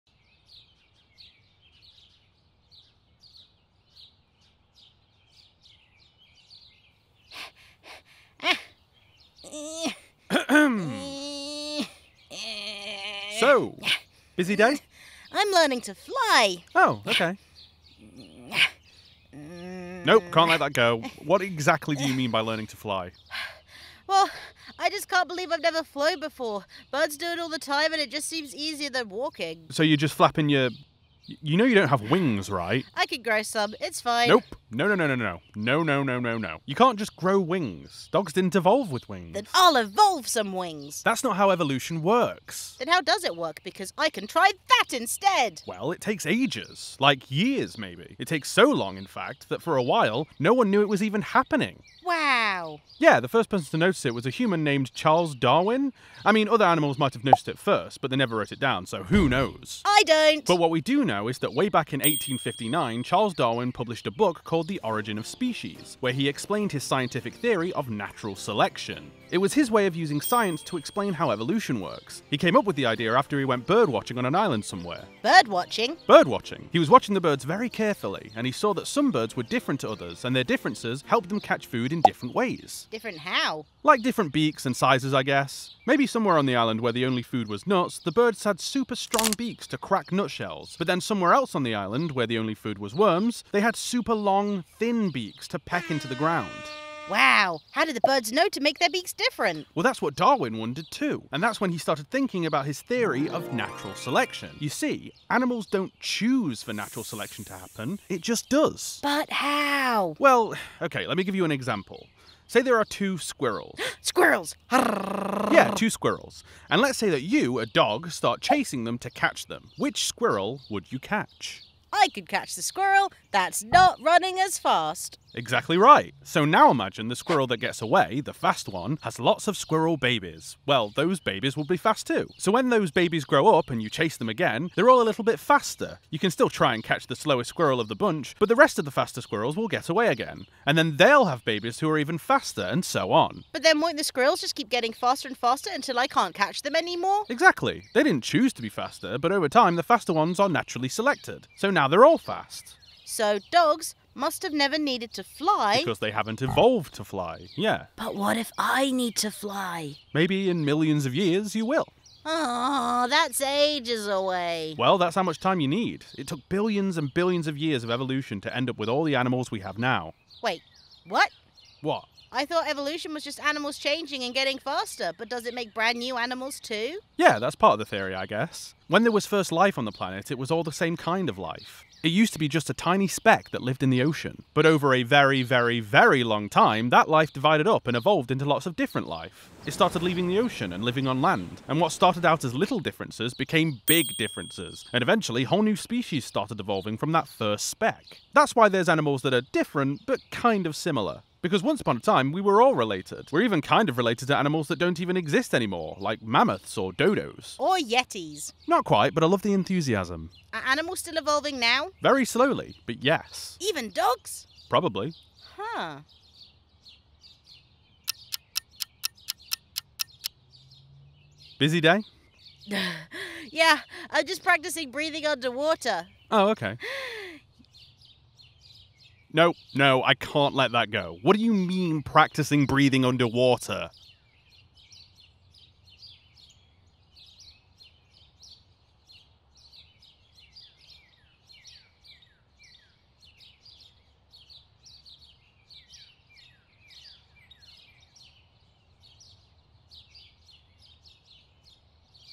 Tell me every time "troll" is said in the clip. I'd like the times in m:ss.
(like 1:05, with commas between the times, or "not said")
not said.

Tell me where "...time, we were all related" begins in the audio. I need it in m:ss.
3:21.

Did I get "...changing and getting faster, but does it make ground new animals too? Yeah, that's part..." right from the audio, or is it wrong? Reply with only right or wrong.
wrong.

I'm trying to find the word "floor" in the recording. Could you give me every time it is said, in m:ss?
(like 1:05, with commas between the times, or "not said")
not said.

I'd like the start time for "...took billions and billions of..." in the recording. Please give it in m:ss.
2:46.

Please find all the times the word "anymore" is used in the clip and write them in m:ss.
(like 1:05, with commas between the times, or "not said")
2:26, 3:25.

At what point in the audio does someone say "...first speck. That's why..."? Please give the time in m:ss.
3:17.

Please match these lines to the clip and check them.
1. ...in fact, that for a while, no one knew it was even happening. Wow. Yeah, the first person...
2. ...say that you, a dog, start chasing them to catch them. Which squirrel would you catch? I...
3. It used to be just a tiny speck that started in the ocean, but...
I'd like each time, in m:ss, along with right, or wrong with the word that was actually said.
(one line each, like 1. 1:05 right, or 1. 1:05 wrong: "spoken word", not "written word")
1. 0:48 right
2. 1:56 right
3. 3:02 wrong: "lived", not "started".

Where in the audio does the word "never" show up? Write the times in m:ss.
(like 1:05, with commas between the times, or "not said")
0:25, 0:58, 2:34.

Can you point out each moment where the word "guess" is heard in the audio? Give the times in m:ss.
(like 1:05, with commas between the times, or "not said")
1:25, 2:58.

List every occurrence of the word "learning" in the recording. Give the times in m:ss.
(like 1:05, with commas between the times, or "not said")
0:15, 0:22.